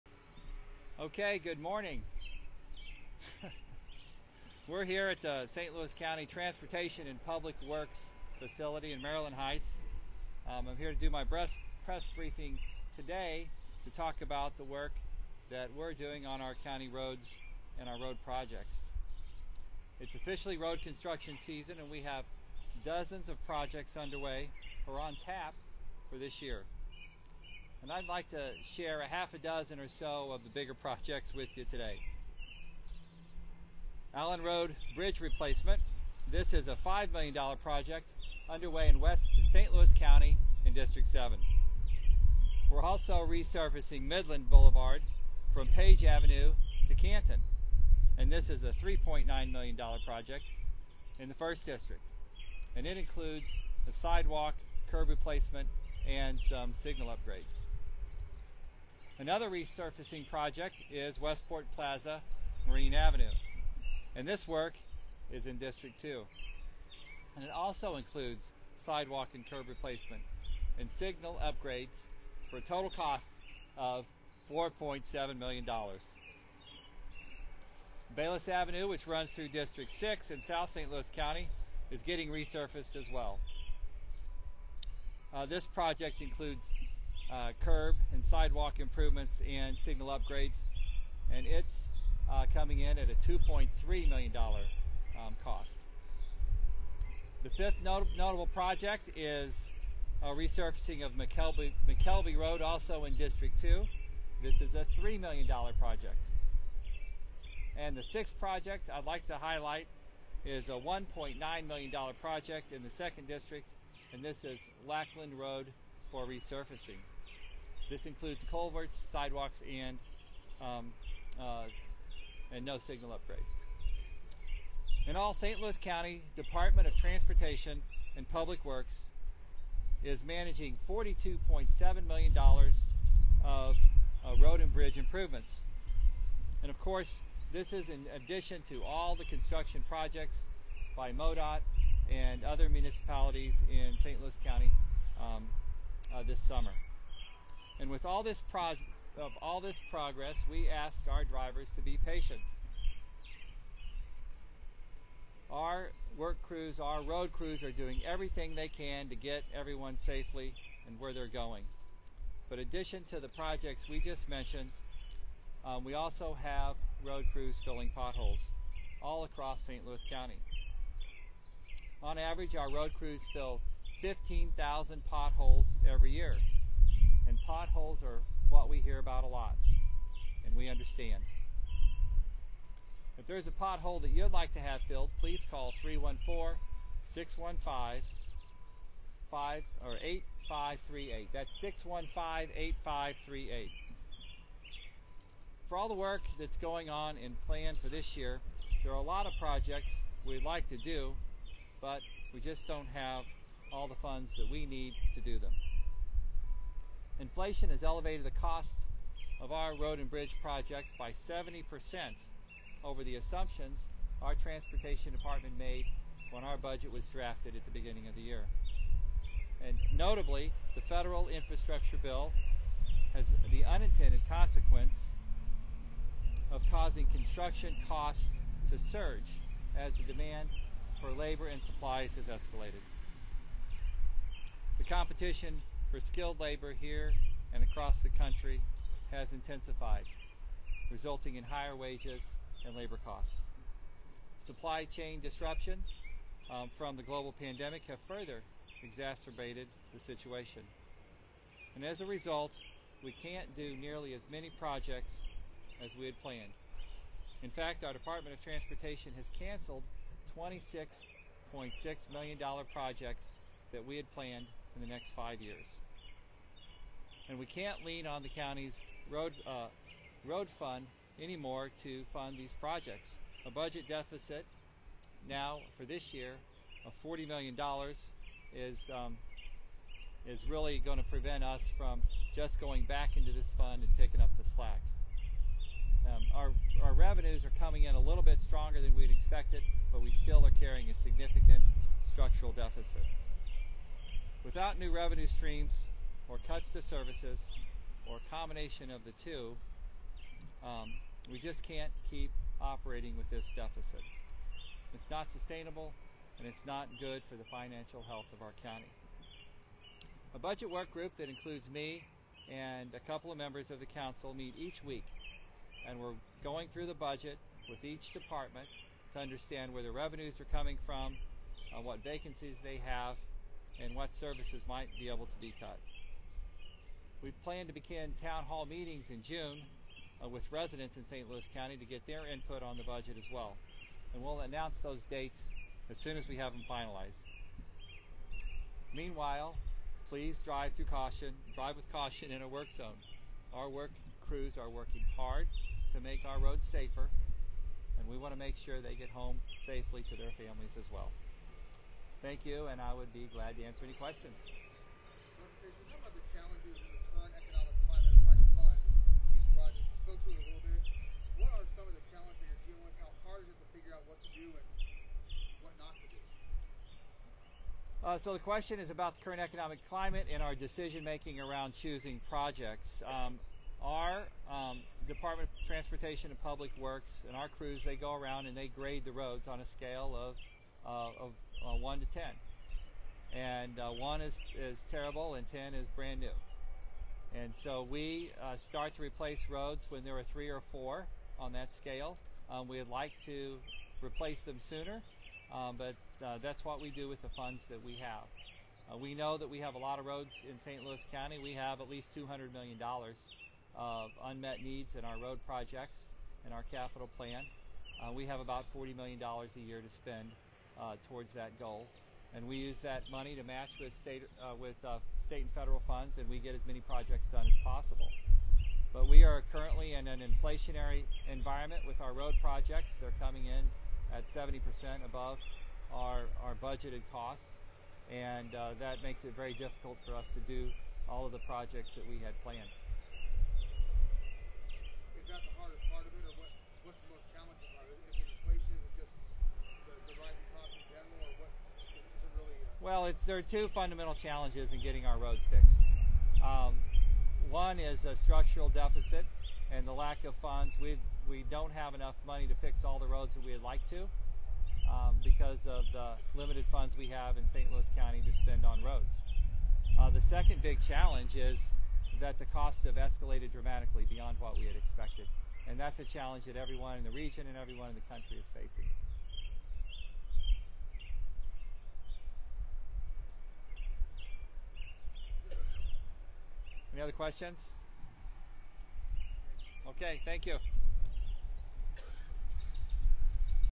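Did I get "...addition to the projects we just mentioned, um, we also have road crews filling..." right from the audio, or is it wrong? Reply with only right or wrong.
right.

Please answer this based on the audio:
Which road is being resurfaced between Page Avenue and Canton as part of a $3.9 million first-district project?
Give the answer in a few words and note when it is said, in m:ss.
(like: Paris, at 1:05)
Midland Boulevard, at 0:44.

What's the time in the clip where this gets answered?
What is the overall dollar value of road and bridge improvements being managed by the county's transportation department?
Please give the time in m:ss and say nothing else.
2:10.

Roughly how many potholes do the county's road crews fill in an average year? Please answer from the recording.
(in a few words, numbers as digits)
15,000.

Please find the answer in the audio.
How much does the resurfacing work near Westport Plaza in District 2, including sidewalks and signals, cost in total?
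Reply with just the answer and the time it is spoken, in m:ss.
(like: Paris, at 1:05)
$4.7 million, at 1:14.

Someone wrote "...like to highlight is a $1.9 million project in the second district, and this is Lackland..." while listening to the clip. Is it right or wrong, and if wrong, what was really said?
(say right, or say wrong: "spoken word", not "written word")
right.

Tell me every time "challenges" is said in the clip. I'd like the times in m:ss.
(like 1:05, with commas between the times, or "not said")
6:02, 7:24, 7:40, 7:46.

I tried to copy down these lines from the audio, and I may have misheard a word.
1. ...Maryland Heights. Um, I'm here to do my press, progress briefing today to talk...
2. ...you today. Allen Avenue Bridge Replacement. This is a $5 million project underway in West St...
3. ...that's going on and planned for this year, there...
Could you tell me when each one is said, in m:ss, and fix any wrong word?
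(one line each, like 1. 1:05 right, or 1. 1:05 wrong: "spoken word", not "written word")
1. 0:09 wrong: "press", not "progress"
2. 0:31 wrong: "Road", not "Avenue"
3. 3:16 right.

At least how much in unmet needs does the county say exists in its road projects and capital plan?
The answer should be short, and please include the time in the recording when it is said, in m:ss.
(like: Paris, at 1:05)
$200 million, at 6:42.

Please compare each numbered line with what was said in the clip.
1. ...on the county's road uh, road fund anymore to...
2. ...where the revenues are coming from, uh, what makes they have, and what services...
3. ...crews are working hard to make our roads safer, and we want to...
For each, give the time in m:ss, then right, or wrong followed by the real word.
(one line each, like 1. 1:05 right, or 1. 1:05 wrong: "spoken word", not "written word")
1. 4:28 right
2. 5:19 wrong: "vacancies", not "makes"
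3. 5:44 right.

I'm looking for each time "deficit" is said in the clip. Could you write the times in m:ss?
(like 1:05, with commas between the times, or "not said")
4:33, 4:52, 5:03, 7:28.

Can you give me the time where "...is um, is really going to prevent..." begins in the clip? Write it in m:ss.
4:38.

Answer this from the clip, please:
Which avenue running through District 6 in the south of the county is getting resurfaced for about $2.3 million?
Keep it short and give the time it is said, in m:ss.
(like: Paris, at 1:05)
Bayless Avenue, at 1:18.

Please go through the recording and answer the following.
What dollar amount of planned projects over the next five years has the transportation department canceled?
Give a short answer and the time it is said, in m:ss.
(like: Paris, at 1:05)
$26.6 million, at 4:20.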